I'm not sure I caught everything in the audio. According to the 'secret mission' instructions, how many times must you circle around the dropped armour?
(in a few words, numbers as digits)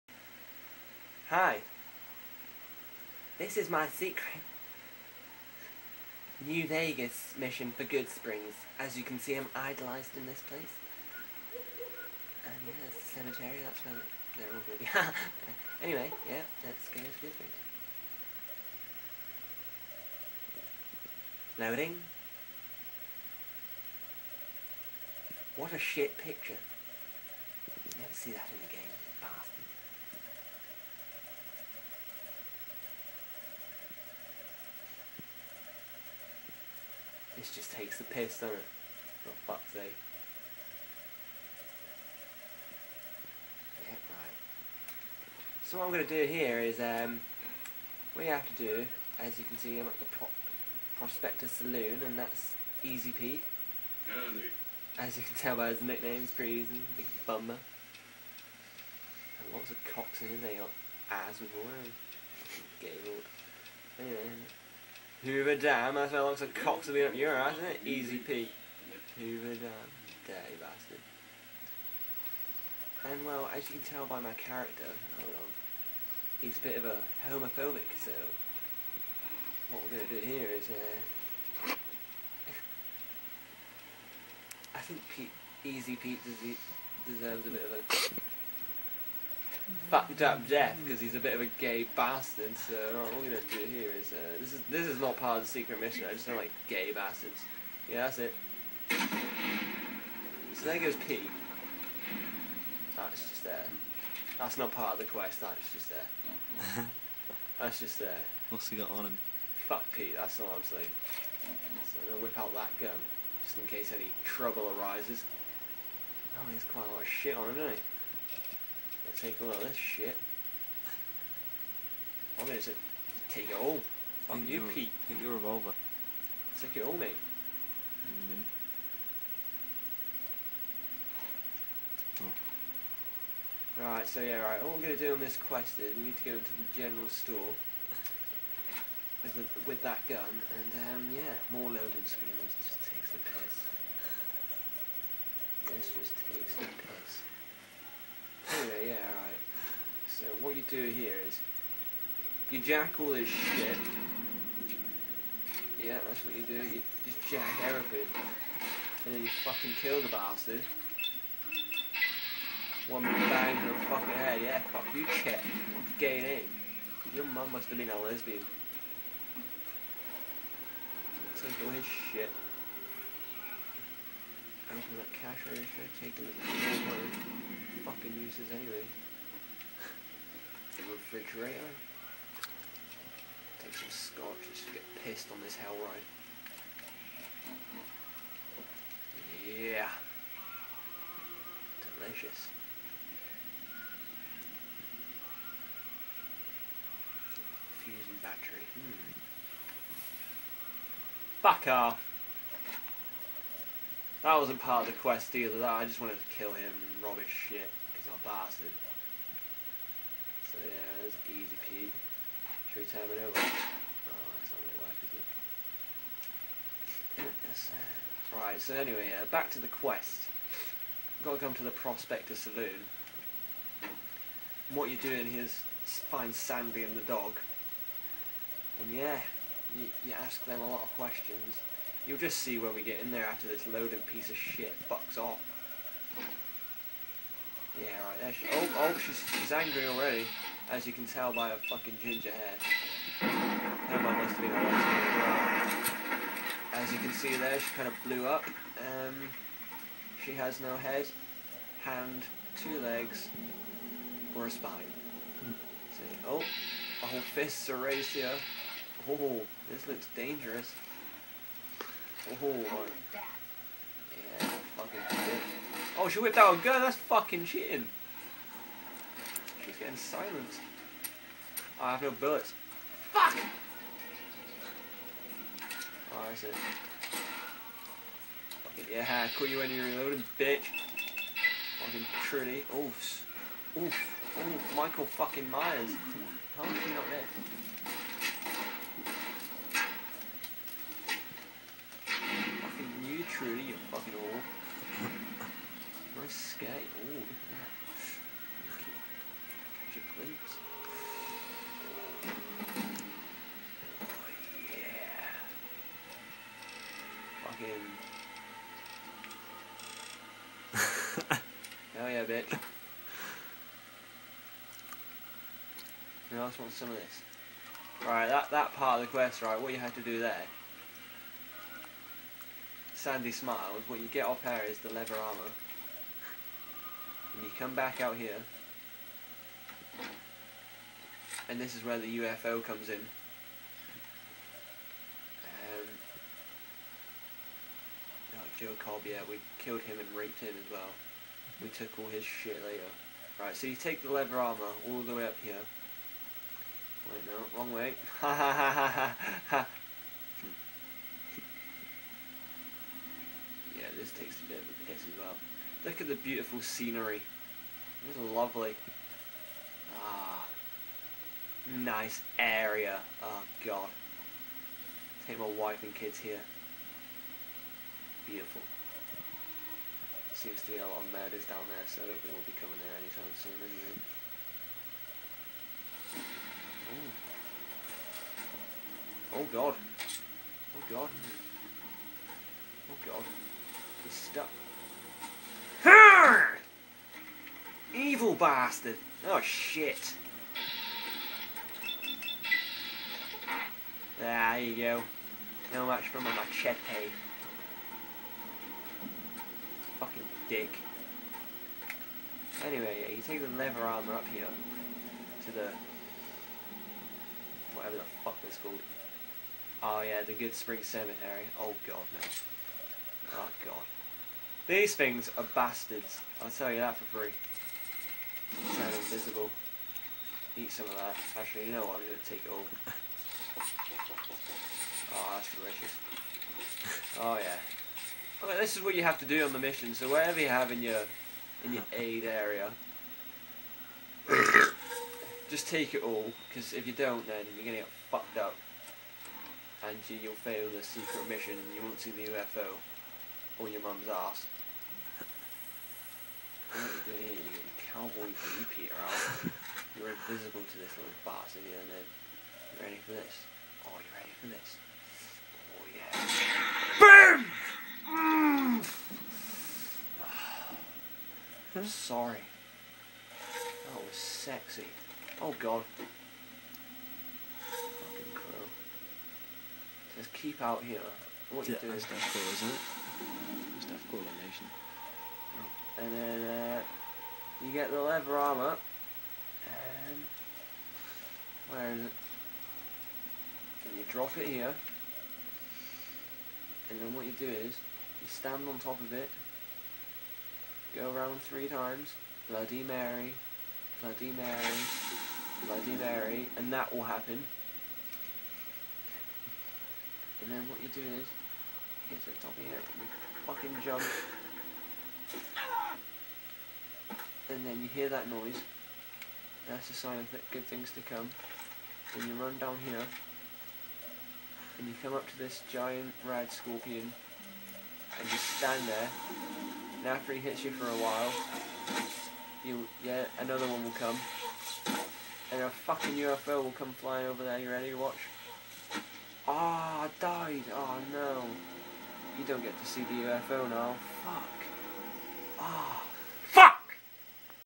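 3.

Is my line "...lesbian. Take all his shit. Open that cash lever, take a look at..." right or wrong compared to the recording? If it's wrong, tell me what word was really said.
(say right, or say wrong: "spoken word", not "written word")
wrong: "register", not "lever".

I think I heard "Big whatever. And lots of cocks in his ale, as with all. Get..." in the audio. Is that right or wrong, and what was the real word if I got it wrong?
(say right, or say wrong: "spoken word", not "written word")
wrong: "bummer", not "whatever".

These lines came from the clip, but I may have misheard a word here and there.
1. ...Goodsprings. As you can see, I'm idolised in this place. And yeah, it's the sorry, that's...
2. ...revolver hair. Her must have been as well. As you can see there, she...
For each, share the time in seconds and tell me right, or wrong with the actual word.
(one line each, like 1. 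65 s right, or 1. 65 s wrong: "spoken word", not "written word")
1. 7 s wrong: "cemetery", not "sorry"
2. 242 s wrong: "ginger", not "revolver".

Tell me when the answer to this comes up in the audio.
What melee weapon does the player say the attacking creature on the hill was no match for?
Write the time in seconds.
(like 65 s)
396 s.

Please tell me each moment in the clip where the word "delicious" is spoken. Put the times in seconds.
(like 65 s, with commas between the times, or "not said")
191 s, 425 s.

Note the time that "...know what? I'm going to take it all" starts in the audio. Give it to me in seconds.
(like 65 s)
421 s.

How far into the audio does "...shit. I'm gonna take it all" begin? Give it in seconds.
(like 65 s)
119 s.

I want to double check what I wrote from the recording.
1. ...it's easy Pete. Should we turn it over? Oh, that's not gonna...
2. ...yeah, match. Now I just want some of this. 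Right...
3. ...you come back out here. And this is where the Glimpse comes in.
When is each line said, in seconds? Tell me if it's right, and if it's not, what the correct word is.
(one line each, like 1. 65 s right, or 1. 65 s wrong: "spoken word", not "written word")
1. 211 s right
2. 312 s wrong: "bitch", not "match"
3. 327 s wrong: "UFO", not "Glimpse".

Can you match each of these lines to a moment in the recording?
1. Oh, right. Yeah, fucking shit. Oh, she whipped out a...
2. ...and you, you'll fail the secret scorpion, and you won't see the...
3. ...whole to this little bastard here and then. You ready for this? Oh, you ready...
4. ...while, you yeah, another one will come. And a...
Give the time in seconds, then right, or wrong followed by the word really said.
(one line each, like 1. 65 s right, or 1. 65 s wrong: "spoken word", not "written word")
1. 262 s right
2. 439 s wrong: "mission", not "scorpion"
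3. 450 s wrong: "invisible", not "whole"
4. 521 s right.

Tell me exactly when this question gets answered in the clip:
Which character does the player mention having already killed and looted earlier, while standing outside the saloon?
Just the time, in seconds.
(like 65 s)
338 s.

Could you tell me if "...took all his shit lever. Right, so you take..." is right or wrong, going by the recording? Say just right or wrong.
wrong.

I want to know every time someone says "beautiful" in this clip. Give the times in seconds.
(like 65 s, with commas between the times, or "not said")
356 s, 368 s.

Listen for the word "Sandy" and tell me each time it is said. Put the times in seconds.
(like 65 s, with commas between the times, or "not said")
226 s, 323 s.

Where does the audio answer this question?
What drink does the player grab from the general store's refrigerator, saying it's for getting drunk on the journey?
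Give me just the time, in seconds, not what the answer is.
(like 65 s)
183 s.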